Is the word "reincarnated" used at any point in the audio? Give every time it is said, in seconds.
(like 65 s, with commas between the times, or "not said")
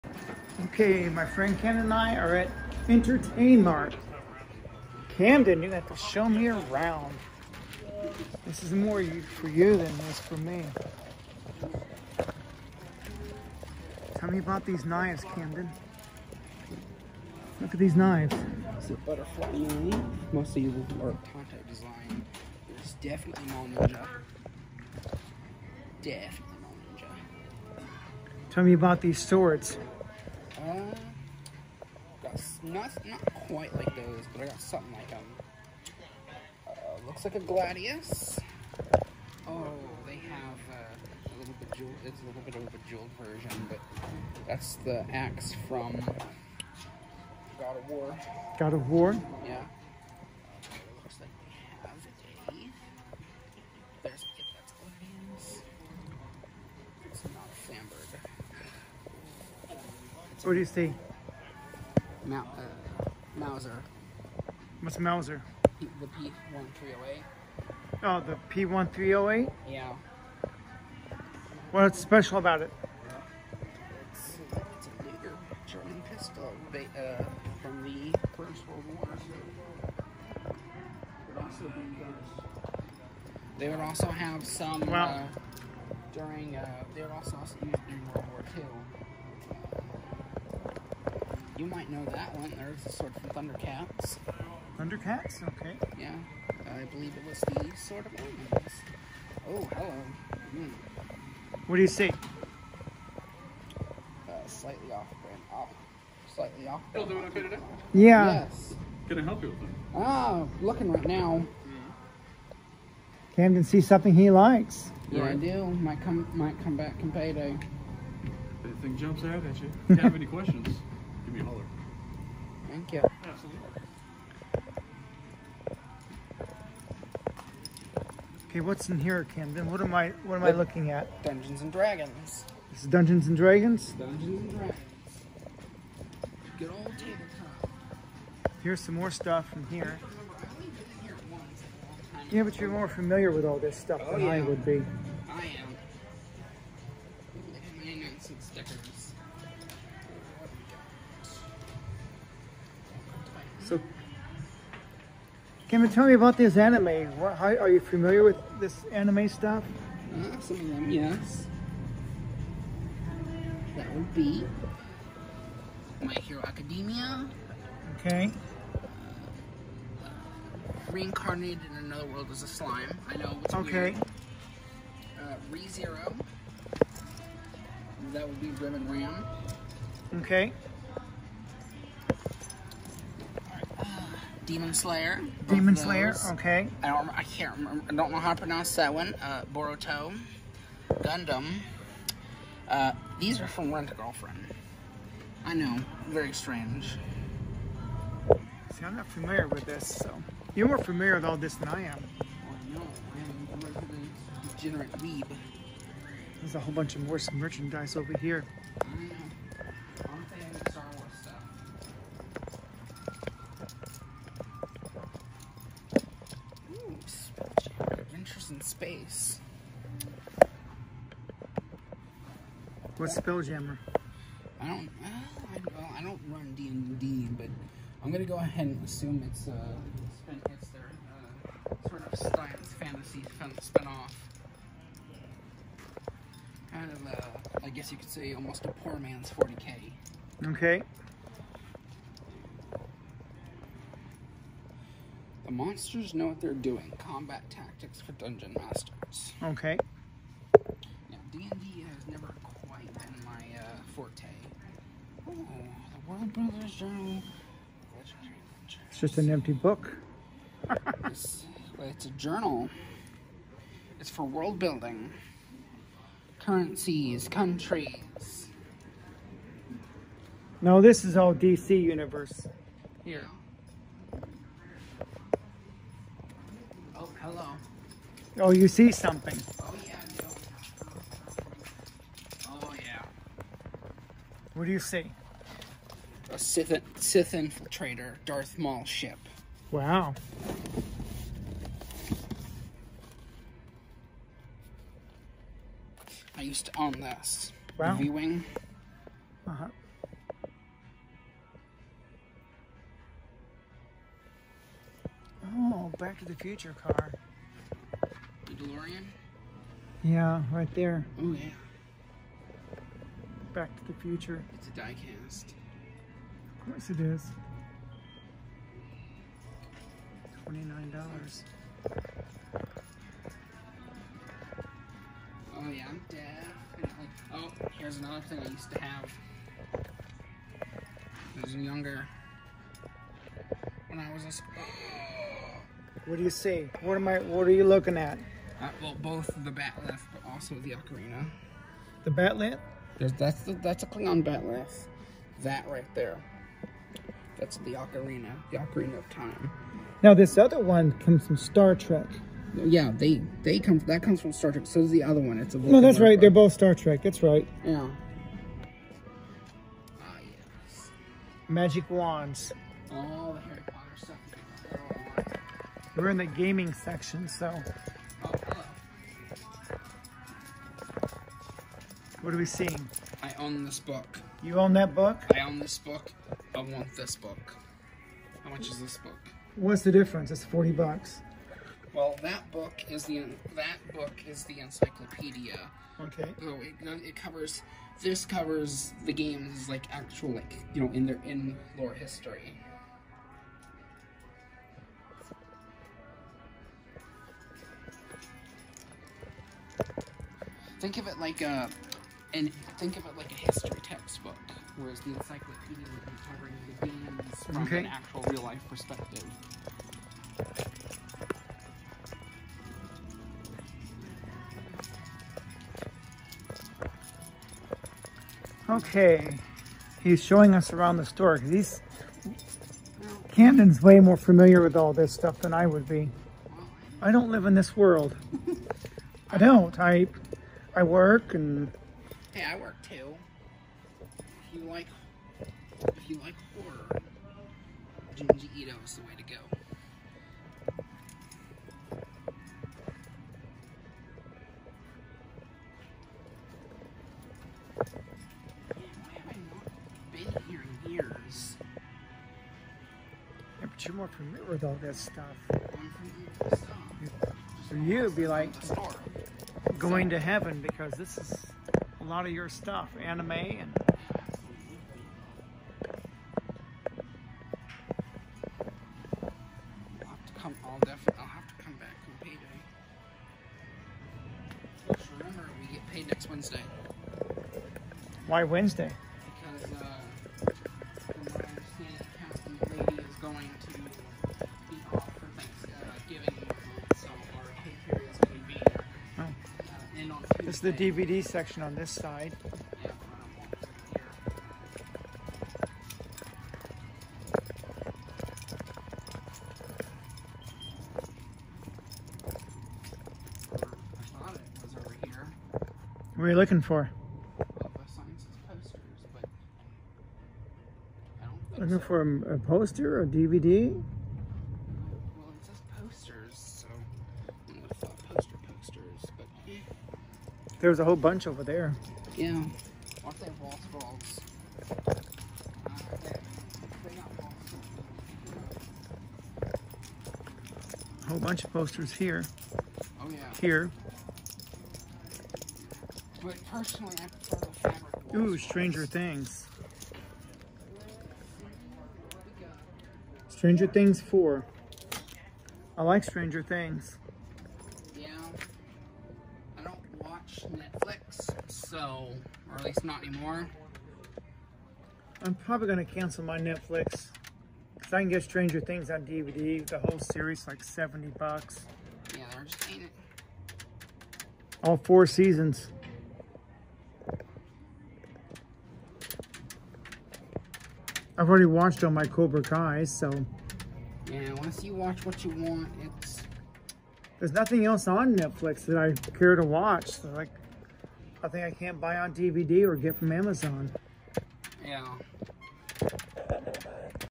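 170 s.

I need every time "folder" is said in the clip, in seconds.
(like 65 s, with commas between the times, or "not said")
not said.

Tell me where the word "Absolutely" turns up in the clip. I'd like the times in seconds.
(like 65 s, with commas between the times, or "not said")
123 s.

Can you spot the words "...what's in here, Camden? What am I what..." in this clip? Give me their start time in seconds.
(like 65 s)
128 s.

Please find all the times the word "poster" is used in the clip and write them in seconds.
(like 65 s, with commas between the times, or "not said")
512 s, 531 s.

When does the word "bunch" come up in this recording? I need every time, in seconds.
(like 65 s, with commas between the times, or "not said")
206 s, 520 s, 531 s.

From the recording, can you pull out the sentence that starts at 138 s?
Here's some more stuff from here.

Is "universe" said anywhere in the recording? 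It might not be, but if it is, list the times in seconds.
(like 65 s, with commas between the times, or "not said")
271 s.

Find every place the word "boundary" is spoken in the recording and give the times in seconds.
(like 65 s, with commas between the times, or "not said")
not said.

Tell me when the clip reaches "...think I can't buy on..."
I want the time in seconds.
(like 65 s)
581 s.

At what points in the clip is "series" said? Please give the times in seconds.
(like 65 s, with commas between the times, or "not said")
559 s.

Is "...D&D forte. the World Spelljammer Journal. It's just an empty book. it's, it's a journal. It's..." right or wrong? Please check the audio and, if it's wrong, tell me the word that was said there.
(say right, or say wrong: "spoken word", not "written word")
wrong: "Builders", not "Spelljammer".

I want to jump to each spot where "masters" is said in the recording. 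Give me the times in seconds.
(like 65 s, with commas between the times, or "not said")
248 s.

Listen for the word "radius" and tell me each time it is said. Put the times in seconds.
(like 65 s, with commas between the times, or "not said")
not said.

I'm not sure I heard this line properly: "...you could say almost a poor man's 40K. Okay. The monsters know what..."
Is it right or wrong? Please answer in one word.
right.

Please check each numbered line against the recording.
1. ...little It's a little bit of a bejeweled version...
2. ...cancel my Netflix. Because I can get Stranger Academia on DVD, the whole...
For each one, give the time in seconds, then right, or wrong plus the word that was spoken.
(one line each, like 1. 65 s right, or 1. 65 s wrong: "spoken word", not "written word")
1. 41 s right
2. 555 s wrong: "Things", not "Academia".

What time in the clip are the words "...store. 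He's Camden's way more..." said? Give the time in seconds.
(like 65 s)
421 s.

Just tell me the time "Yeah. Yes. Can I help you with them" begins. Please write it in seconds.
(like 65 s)
107 s.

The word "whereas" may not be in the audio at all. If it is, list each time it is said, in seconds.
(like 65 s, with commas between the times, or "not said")
404 s.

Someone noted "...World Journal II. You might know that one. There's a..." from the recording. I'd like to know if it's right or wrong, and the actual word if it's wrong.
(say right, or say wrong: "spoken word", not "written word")
wrong: "War", not "Journal".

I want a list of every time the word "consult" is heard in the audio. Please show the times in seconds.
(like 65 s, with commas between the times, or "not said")
not said.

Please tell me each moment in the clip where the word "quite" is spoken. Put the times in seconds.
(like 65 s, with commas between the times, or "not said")
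33 s.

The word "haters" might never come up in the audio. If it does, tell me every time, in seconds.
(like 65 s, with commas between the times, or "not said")
not said.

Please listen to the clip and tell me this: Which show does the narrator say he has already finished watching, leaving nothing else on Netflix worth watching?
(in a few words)
Cobra Kai.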